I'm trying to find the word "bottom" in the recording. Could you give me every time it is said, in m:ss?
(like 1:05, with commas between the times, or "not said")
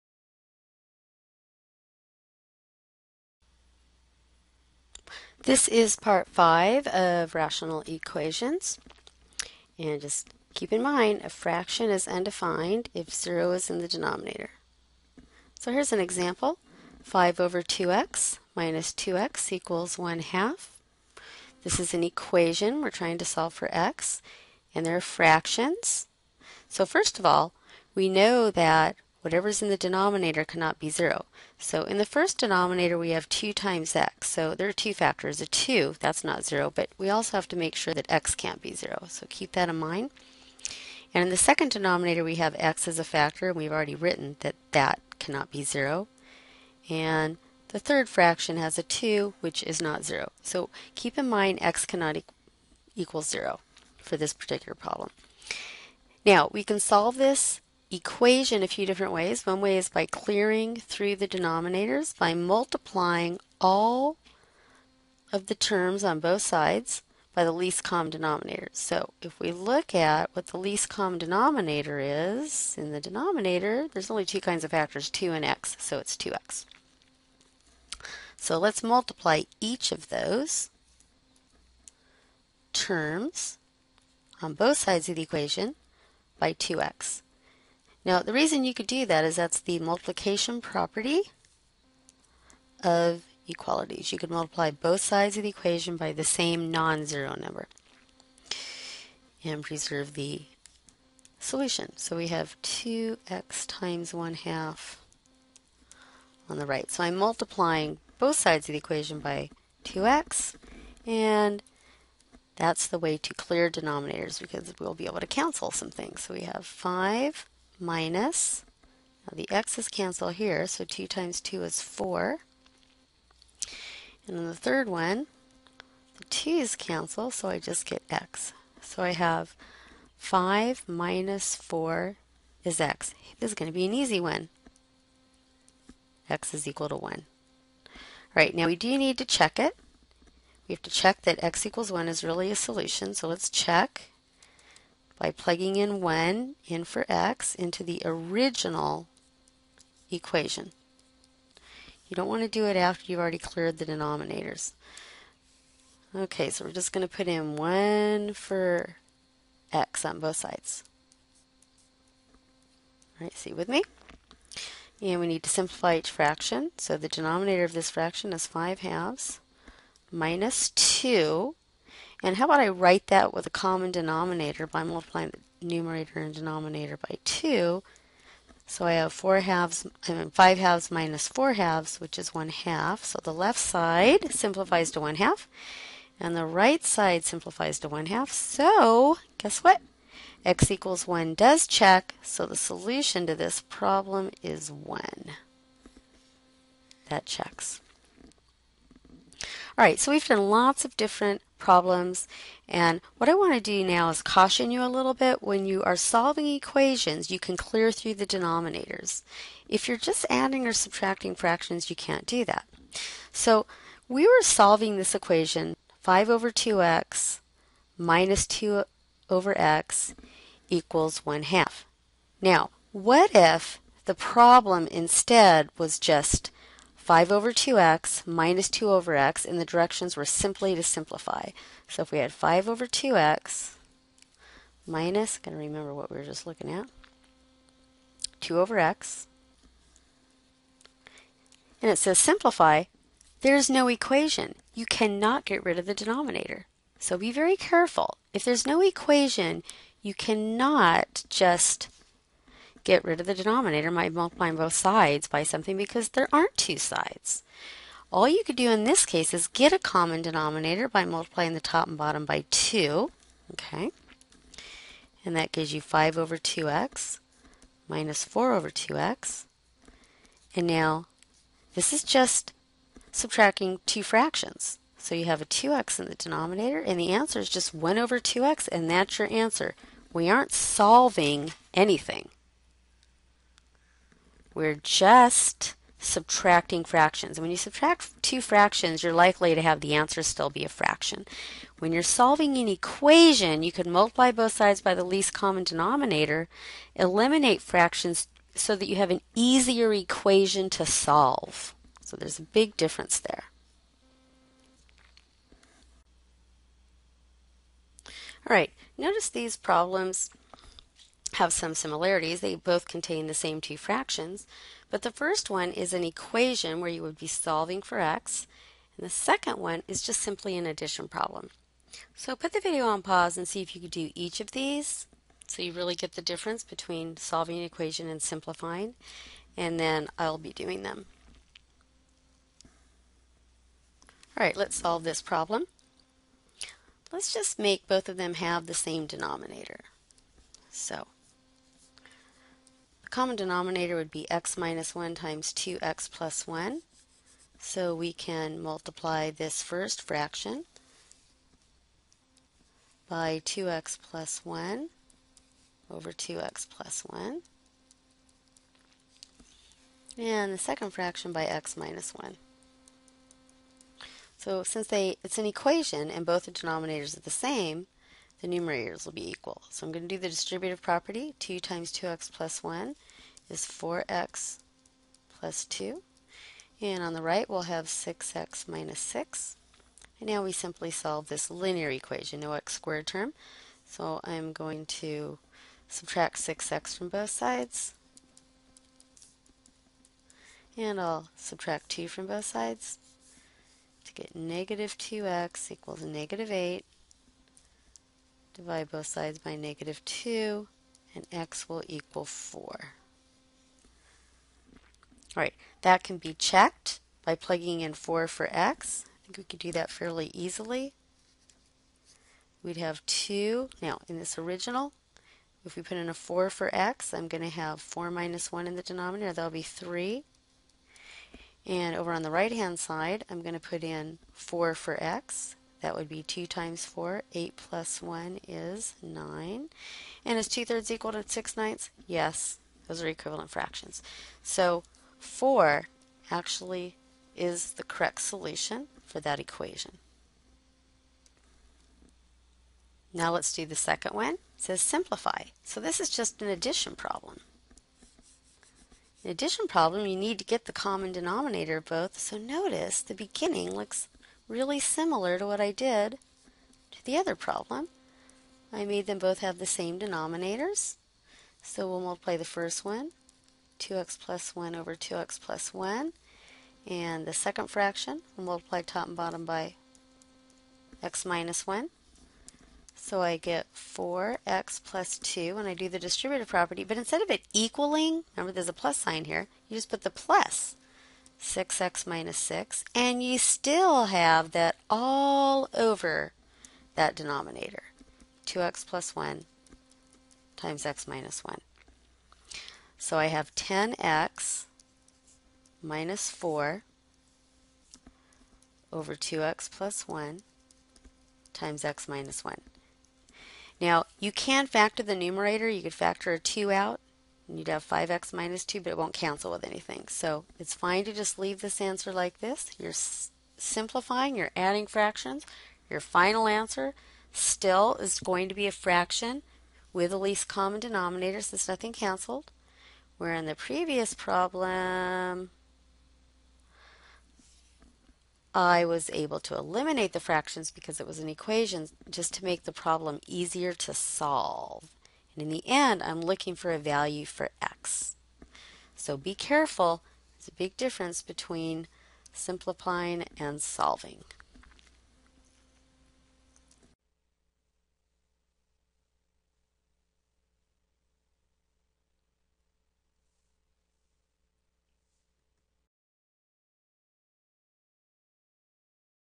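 4:21, 7:49.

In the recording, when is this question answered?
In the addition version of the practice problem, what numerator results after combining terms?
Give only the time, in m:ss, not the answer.
8:13.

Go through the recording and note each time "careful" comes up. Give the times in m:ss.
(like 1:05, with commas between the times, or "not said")
4:07, 8:59.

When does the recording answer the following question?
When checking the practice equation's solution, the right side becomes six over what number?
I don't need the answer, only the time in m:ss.
7:09.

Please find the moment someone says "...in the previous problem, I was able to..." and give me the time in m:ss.
8:43.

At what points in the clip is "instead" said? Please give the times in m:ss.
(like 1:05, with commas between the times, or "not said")
3:44, 7:56.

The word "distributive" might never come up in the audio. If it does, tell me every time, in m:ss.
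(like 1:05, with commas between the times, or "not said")
6:10, 7:55.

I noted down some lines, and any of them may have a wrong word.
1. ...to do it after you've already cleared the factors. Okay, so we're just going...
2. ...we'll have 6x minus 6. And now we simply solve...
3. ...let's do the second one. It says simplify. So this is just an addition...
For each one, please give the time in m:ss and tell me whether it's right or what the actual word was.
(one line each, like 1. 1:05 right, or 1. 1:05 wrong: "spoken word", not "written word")
1. 2:32 wrong: "denominators", not "factors"
2. 6:17 right
3. 7:23 right.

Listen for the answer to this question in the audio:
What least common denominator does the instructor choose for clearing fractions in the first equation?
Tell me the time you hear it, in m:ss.
1:15.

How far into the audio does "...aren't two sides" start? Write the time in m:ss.
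4:16.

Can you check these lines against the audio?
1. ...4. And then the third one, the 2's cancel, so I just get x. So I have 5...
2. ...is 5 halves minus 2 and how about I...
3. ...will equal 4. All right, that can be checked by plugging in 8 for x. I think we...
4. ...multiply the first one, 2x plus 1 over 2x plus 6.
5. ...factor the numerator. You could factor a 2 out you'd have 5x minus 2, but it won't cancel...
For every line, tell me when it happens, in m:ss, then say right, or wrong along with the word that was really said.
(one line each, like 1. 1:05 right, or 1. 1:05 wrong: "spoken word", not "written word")
1. 2:01 right
2. 2:48 right
3. 6:41 wrong: "4", not "8"
4. 7:42 wrong: "1", not "6"
5. 8:24 right.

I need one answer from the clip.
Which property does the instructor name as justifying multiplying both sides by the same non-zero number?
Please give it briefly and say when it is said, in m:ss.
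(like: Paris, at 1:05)
multiplication property of equalities, at 1:29.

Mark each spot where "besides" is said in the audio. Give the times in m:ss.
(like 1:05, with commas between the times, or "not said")
not said.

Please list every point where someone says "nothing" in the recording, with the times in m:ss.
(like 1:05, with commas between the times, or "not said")
8:41.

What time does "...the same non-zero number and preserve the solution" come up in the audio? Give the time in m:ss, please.
1:36.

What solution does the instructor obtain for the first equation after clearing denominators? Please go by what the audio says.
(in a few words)
1.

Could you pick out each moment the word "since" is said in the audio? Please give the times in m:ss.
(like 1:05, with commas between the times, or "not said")
6:04, 8:41.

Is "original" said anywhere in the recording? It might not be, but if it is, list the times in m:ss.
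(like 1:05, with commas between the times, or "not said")
2:28, 6:54.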